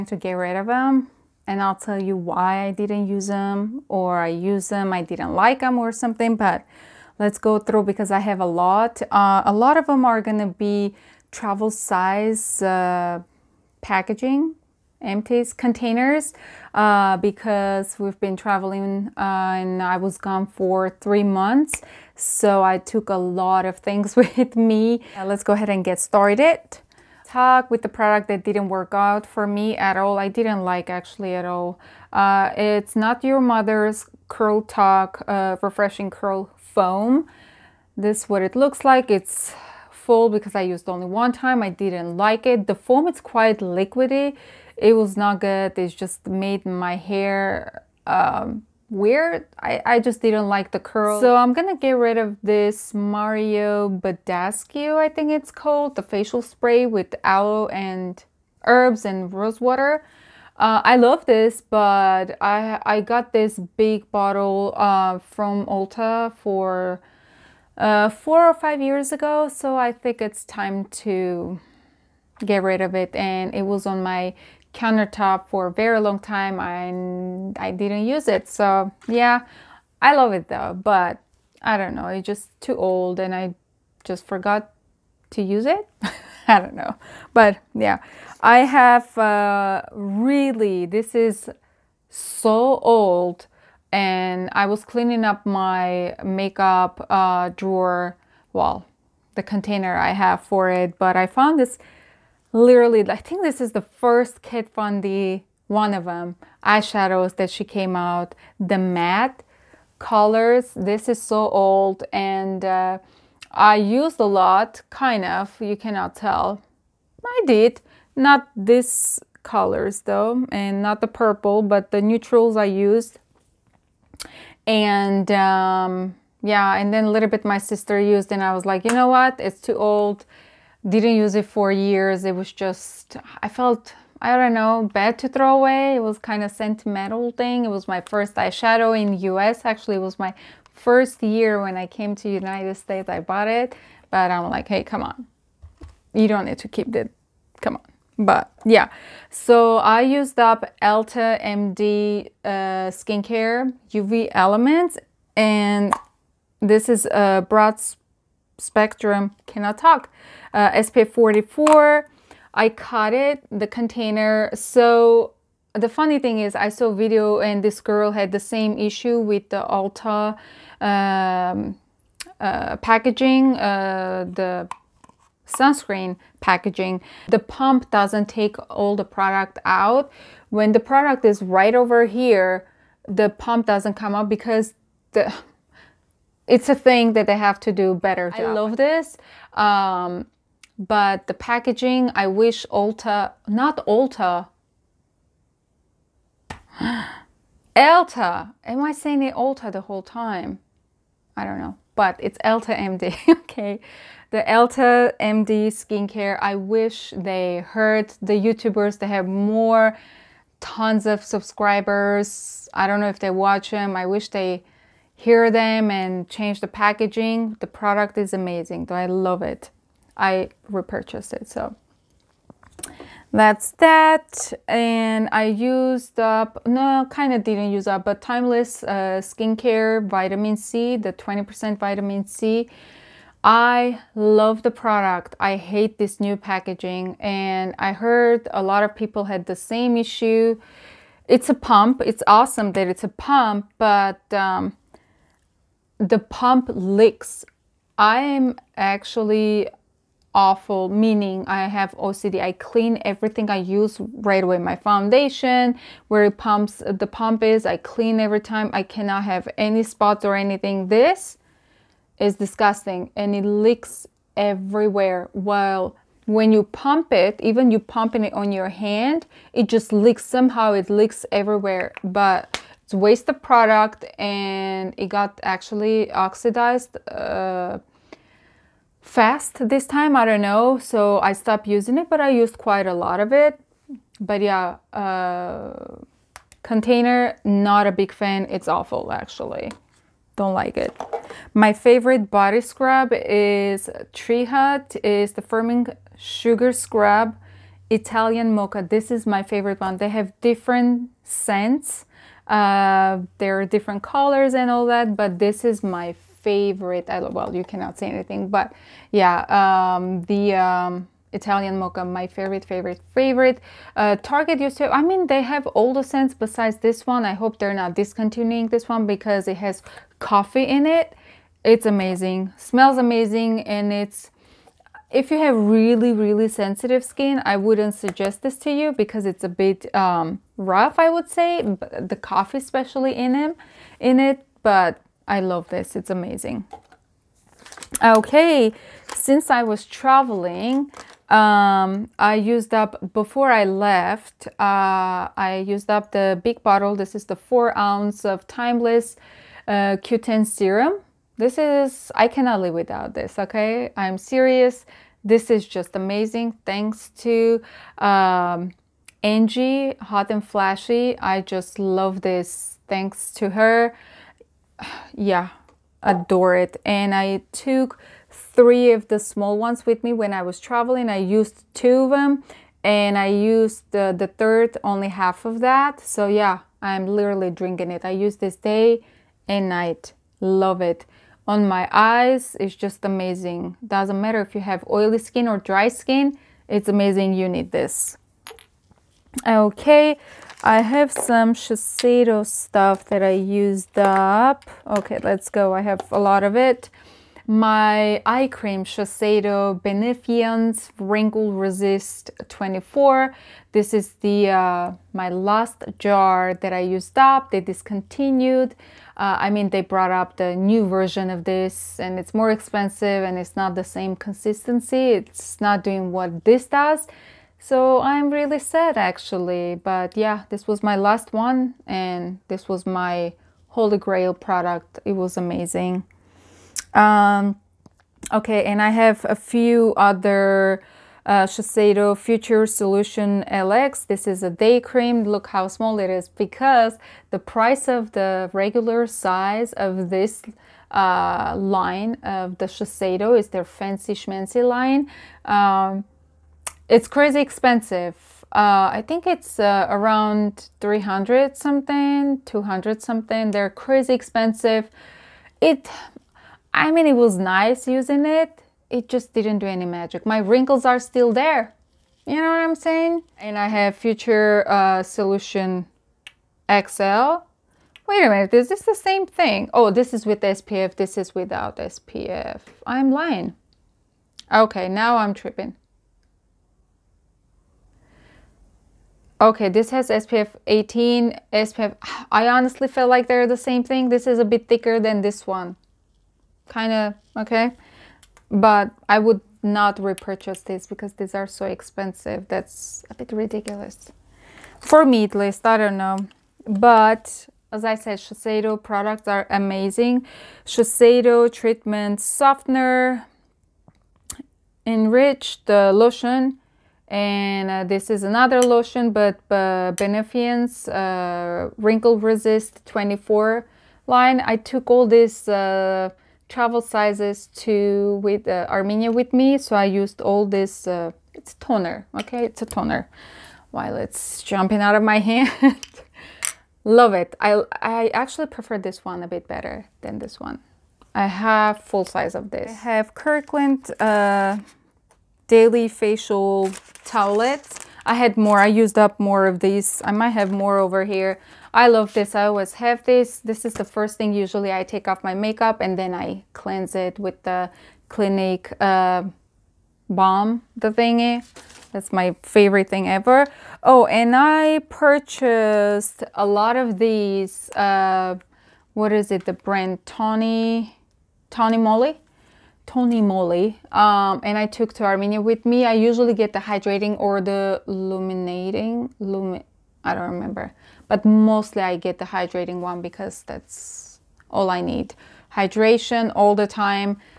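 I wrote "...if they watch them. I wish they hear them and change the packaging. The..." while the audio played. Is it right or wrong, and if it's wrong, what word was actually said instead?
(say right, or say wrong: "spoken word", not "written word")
right.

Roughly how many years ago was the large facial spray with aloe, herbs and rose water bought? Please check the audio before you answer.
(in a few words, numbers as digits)
4 or 5.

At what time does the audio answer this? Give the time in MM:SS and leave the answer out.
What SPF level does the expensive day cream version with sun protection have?
08:00.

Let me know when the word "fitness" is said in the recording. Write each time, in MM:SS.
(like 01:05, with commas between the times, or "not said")
not said.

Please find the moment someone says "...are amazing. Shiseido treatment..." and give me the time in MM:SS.
08:19.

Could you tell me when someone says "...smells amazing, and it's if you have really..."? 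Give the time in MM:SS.
05:22.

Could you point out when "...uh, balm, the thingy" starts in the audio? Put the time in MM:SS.
09:08.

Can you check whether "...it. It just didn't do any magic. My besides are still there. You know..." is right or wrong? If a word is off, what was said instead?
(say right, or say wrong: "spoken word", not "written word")
wrong: "wrinkles", not "besides".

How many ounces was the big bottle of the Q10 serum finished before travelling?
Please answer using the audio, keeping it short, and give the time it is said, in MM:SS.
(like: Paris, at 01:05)
4, at 05:47.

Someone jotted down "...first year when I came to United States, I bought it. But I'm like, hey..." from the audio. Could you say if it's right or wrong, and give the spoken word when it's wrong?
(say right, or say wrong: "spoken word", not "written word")
right.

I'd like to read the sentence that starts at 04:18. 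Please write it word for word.
I cannot have any spots or anything.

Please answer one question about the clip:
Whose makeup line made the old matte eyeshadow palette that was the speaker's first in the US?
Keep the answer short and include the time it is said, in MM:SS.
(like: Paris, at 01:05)
Kat Von D, at 01:44.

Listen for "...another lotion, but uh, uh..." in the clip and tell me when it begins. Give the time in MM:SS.
08:28.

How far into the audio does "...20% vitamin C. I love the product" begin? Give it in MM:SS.
03:51.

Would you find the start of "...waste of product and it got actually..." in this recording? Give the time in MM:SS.
04:32.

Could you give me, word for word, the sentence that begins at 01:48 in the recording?
The matte colors, this is so old and uh, I used a lot, kind of, you cannot tell.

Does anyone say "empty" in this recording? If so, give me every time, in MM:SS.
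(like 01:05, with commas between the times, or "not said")
00:15.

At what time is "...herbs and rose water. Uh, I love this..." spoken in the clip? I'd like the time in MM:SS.
00:58.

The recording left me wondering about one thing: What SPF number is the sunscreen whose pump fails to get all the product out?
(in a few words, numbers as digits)
44.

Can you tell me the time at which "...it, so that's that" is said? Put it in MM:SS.
03:41.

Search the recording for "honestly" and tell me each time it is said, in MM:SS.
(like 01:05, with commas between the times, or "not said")
08:02.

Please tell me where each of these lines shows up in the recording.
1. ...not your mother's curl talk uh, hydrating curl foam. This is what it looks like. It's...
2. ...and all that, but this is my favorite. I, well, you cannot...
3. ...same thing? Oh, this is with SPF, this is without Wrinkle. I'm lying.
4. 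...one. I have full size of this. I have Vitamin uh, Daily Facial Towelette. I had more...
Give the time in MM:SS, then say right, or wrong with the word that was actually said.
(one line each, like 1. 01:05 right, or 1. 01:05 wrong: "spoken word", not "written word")
1. 00:32 wrong: "refreshing", not "hydrating"
2. 05:04 right
3. 07:48 wrong: "SPF", not "Wrinkle"
4. 08:50 wrong: "Kirkland", not "Vitamin".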